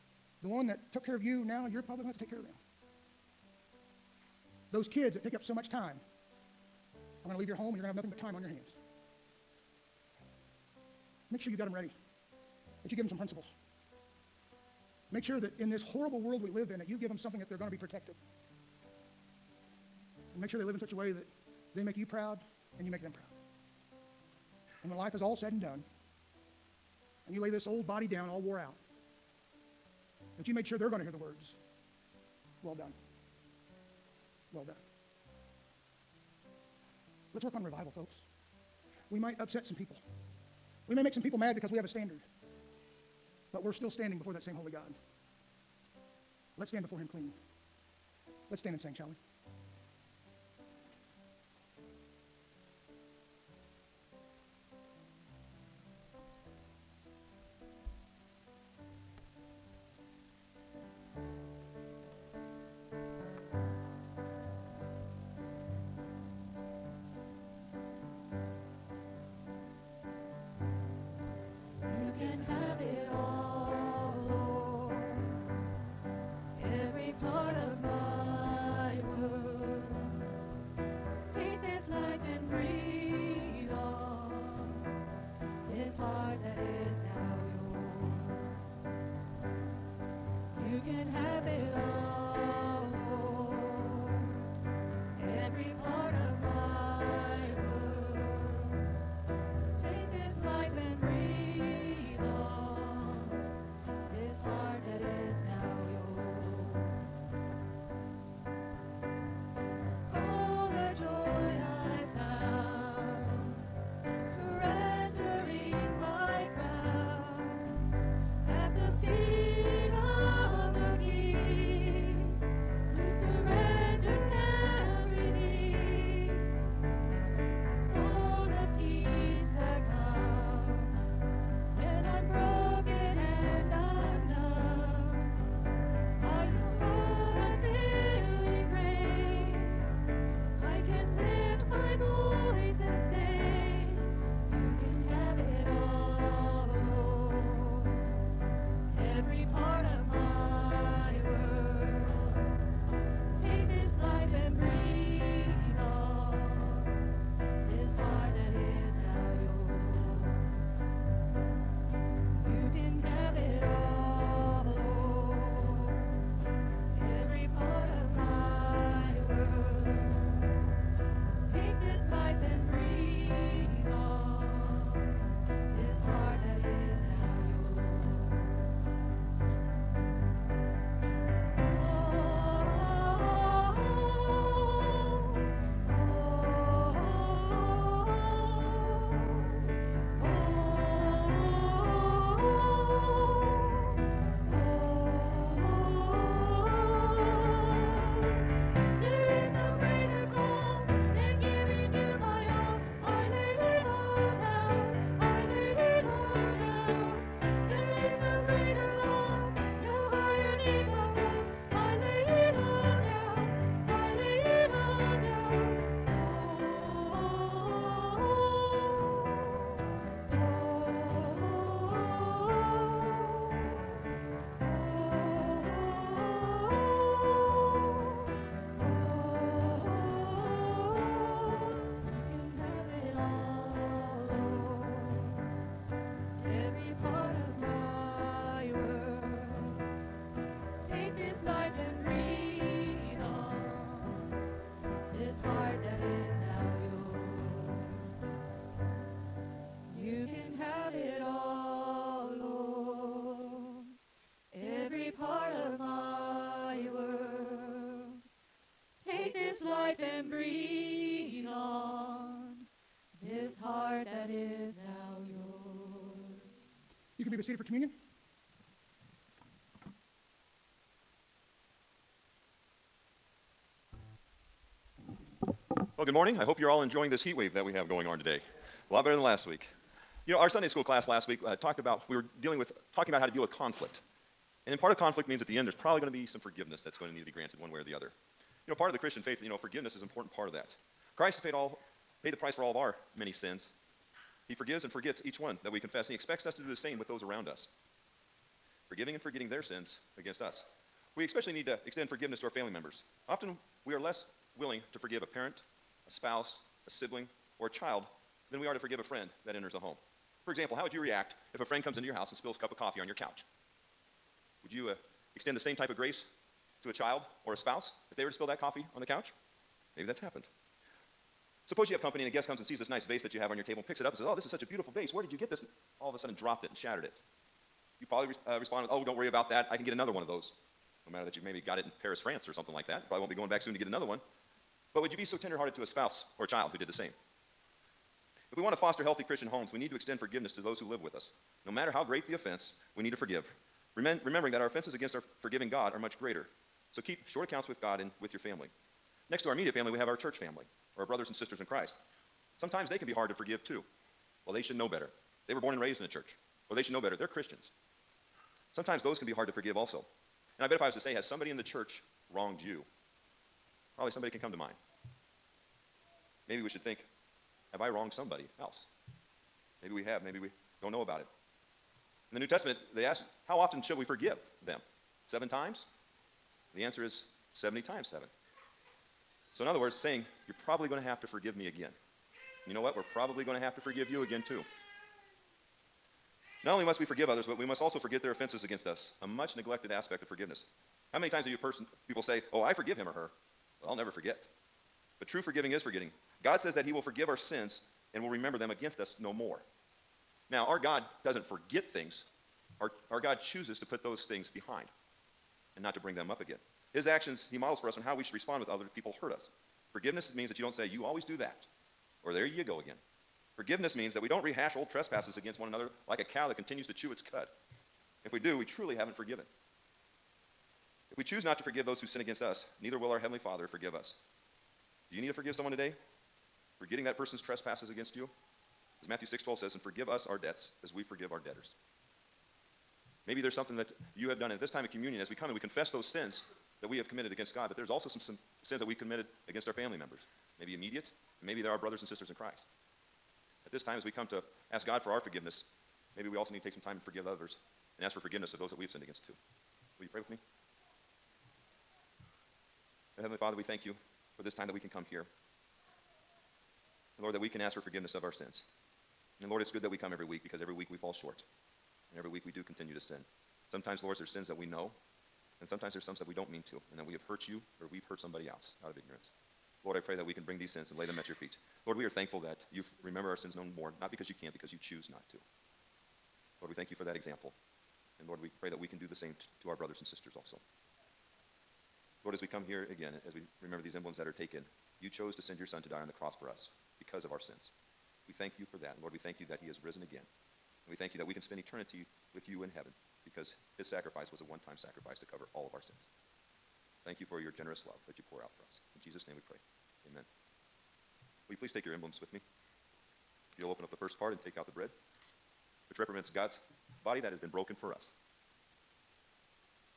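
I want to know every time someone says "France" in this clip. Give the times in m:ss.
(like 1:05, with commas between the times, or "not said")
5:32.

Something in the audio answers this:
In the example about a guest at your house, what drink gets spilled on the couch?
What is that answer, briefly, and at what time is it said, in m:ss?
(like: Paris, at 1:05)
A cup of coffee, at 5:12.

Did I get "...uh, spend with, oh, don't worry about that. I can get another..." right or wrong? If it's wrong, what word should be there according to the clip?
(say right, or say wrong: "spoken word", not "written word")
wrong: "respond", not "spend".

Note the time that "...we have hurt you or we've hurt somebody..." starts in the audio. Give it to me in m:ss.
7:47.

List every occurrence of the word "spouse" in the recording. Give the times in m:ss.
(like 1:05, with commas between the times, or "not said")
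5:06, 5:17, 5:35.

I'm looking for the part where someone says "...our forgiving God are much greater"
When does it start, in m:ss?
5:45.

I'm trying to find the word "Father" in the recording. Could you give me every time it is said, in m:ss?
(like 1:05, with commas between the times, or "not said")
7:03, 7:33.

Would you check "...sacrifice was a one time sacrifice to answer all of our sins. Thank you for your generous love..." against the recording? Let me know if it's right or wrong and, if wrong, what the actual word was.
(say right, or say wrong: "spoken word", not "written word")
wrong: "cover", not "answer".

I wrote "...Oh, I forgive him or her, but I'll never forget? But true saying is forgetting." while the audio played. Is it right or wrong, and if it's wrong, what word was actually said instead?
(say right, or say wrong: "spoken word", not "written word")
wrong: "forgiving", not "saying".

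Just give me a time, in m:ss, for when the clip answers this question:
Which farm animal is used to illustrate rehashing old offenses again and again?
6:56.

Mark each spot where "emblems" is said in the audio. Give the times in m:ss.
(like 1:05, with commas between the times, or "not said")
8:03, 8:21.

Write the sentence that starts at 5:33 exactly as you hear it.
probably won't be going back soon to get another one.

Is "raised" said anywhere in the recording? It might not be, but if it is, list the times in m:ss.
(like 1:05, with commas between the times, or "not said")
5:55.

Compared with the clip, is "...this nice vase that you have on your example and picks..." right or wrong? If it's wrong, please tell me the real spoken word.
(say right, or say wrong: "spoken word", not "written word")
wrong: "table", not "example".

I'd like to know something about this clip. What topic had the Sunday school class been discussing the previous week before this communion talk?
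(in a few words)
How to deal with conflict.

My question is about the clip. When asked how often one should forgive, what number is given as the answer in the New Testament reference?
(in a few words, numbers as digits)
70 times 7.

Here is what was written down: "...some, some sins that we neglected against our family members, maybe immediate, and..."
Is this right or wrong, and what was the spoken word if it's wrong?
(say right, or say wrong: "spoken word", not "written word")
wrong: "committed", not "neglected".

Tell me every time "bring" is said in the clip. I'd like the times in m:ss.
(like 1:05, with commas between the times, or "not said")
6:45, 7:50.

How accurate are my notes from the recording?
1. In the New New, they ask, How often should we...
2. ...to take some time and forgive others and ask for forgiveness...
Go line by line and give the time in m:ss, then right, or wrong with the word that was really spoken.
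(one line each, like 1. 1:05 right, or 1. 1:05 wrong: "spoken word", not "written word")
1. 6:12 wrong: "Testament", not "New"
2. 7:26 right.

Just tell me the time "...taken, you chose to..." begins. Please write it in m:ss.
8:04.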